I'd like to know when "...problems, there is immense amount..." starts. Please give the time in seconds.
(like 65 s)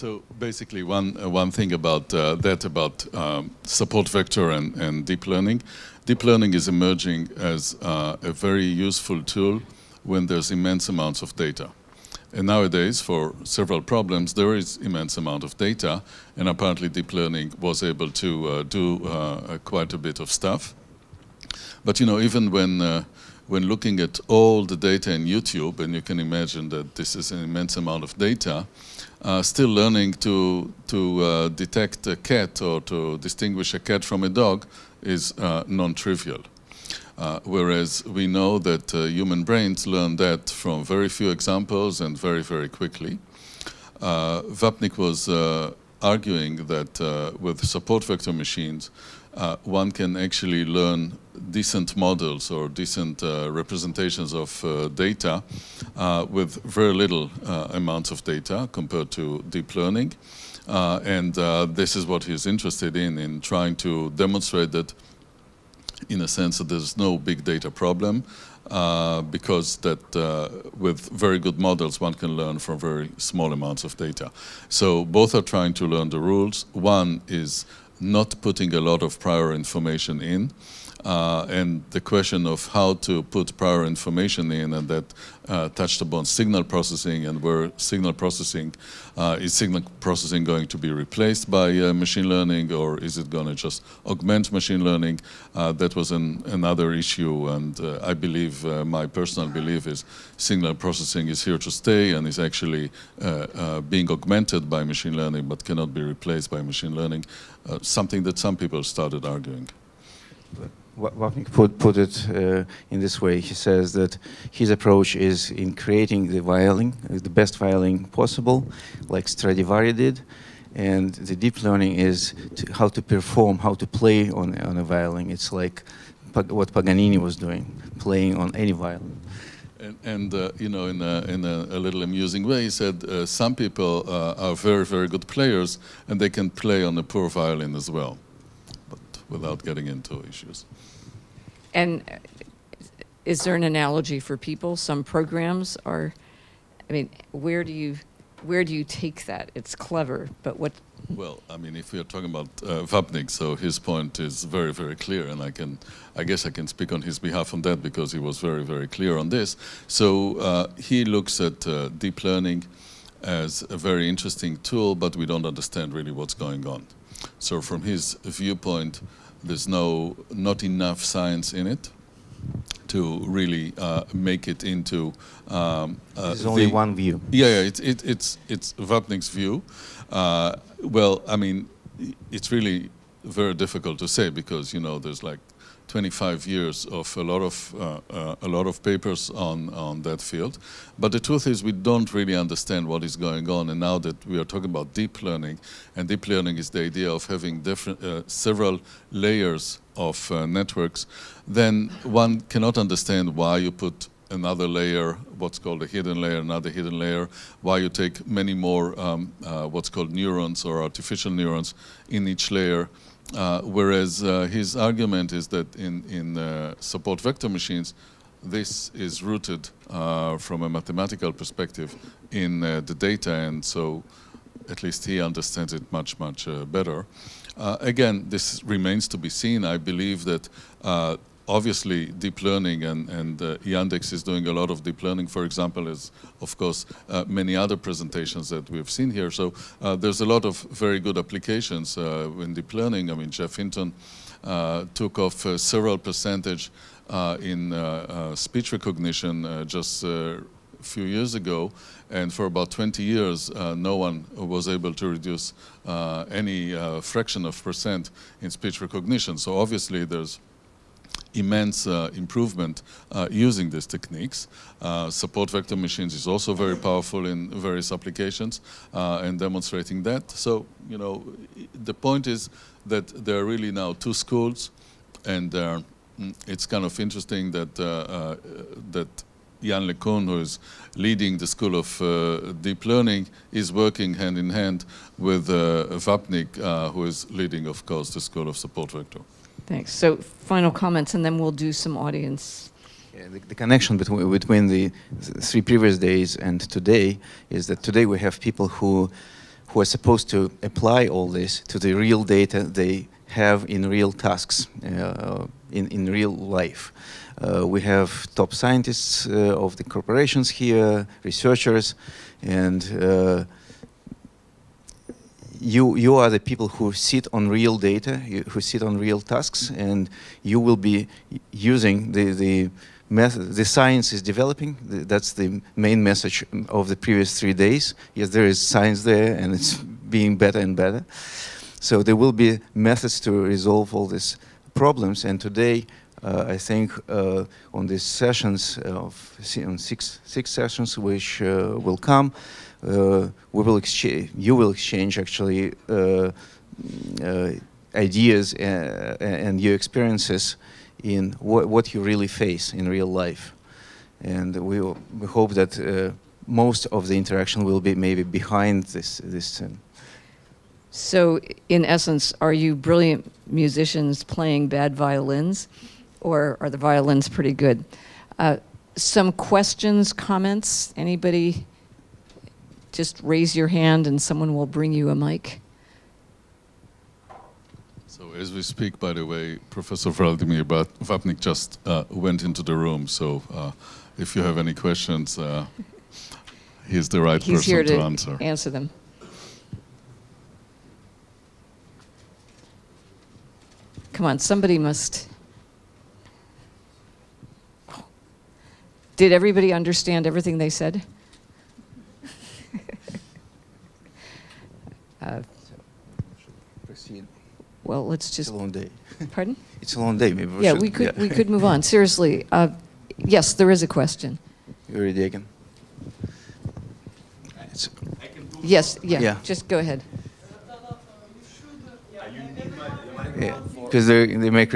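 13 s.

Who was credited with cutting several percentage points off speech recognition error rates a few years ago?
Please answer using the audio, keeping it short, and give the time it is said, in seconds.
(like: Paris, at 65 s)
Geoff Hinton, at 243 s.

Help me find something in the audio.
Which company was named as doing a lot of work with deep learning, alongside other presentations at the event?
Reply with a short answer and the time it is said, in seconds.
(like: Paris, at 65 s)
Yandex, at 233 s.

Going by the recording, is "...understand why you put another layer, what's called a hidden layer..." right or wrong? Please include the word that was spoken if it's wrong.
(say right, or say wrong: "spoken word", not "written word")
right.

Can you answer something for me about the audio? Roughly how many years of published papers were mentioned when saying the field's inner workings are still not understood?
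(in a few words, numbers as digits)
25.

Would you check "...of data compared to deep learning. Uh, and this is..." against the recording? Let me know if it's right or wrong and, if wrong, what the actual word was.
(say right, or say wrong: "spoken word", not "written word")
right.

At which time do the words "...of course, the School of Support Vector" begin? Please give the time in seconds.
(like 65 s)
287 s.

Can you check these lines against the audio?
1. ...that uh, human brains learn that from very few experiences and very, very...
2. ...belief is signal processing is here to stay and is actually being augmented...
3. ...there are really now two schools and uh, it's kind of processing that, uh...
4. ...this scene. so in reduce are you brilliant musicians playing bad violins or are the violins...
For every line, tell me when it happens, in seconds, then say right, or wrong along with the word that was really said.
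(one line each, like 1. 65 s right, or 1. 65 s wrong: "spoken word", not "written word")
1. 38 s wrong: "examples", not "experiences"
2. 99 s right
3. 273 s wrong: "interesting", not "processing"
4. 359 s wrong: "essence", not "reduce".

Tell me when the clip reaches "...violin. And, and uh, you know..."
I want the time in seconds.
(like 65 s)
128 s.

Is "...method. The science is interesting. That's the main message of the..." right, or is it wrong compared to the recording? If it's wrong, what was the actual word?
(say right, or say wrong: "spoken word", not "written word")
wrong: "developing", not "interesting".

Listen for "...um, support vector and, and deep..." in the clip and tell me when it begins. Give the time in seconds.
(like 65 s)
3 s.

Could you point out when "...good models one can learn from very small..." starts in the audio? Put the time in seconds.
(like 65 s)
71 s.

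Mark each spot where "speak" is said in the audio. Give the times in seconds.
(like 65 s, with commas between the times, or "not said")
156 s, 378 s.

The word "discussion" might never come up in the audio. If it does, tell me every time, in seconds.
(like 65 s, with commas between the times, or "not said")
not said.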